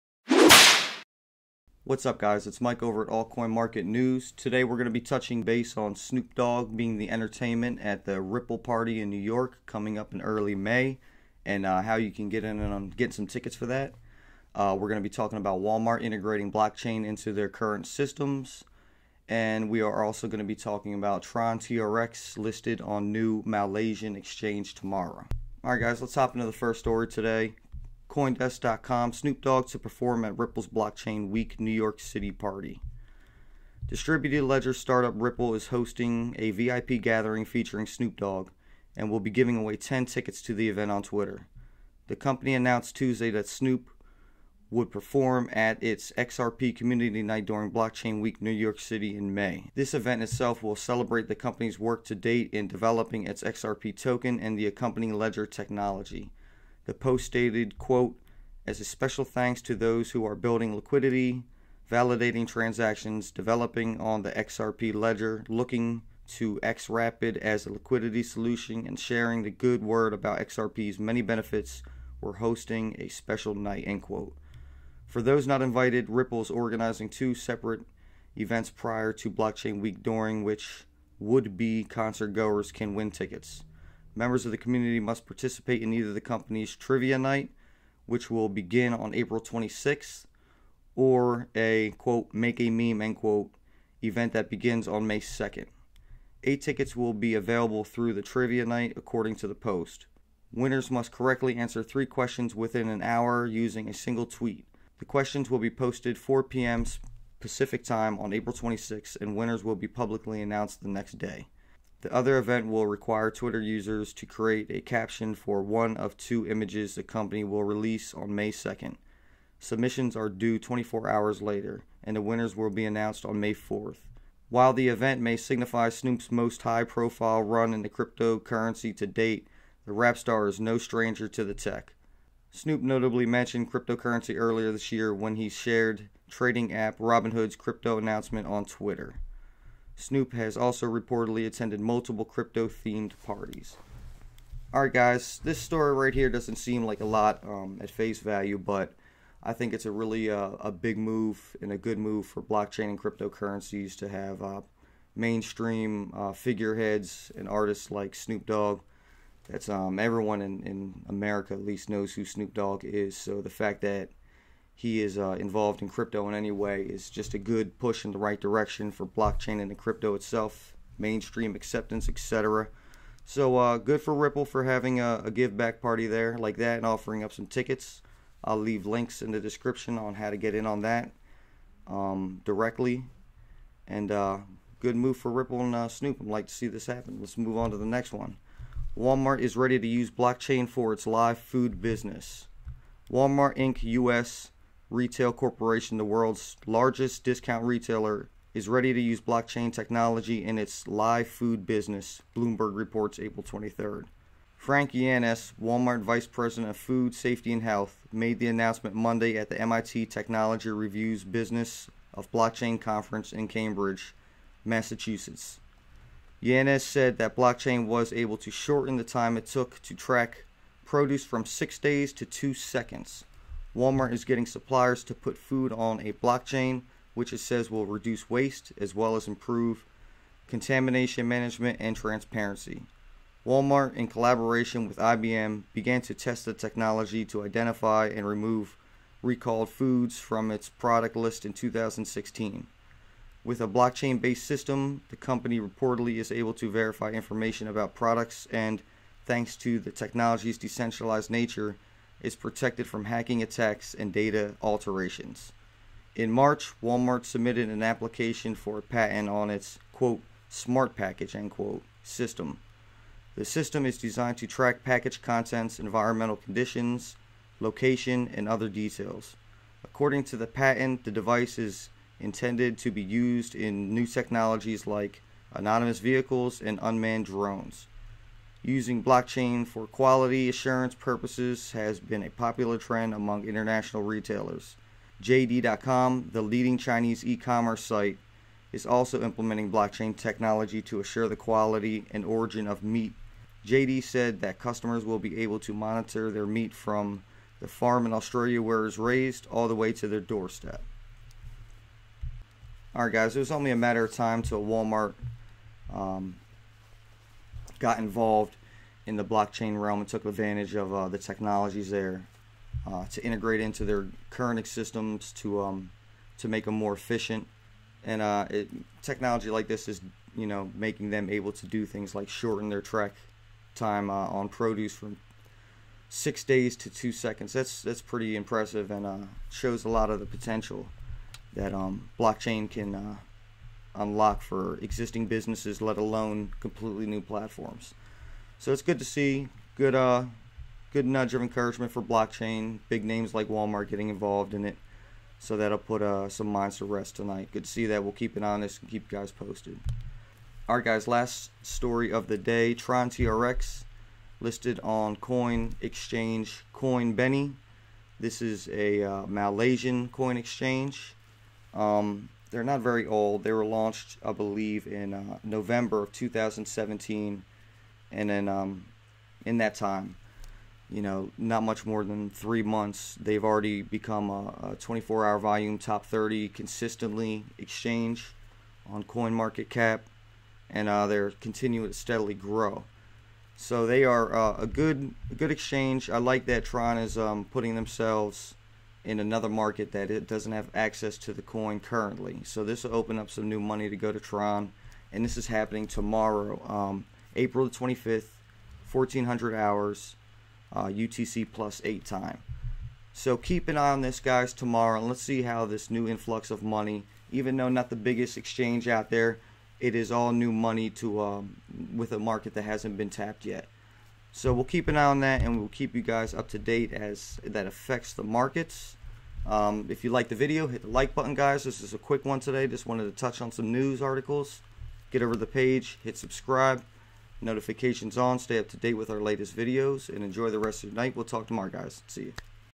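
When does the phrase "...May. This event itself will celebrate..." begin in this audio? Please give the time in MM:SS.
00:49.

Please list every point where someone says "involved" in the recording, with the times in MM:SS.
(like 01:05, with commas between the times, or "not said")
02:45, 05:07, 05:44.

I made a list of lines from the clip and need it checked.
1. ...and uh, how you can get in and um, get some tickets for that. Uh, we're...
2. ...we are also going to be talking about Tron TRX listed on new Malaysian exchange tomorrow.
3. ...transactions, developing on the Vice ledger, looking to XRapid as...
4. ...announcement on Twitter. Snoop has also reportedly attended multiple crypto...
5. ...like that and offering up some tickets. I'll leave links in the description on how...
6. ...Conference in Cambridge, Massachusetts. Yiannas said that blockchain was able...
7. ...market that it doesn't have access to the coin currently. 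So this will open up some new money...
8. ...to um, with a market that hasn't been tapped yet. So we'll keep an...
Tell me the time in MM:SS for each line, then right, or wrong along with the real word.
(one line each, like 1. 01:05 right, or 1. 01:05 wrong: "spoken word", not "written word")
1. 00:11 right
2. 00:19 right
3. 01:02 wrong: "XRP", not "Vice"
4. 02:17 right
5. 02:56 right
6. 03:32 right
7. 06:29 right
8. 06:50 right.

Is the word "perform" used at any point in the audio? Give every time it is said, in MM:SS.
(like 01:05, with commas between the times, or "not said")
00:29, 00:44.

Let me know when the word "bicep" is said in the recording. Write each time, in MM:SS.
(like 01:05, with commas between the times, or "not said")
not said.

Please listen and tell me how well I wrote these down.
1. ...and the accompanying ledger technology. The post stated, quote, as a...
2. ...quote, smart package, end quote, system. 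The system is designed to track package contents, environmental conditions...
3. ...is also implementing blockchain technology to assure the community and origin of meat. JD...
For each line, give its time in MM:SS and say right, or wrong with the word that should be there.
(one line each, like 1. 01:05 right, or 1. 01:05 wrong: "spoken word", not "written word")
1. 00:54 right
2. 04:19 right
3. 04:48 wrong: "quality", not "community".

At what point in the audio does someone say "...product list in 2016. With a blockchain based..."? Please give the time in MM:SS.
04:00.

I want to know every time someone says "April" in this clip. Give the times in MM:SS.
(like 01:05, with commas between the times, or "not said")
01:29, 01:48, 03:23, 06:37.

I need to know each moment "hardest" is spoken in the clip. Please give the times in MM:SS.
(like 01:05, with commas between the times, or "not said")
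not said.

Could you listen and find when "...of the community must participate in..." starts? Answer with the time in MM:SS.
01:24.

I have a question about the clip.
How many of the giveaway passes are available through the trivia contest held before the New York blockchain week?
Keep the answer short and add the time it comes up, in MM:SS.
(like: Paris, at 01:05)
8, at 01:36.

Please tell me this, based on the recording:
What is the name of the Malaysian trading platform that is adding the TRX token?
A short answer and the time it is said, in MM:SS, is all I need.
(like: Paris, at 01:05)
CoinBene, at 05:56.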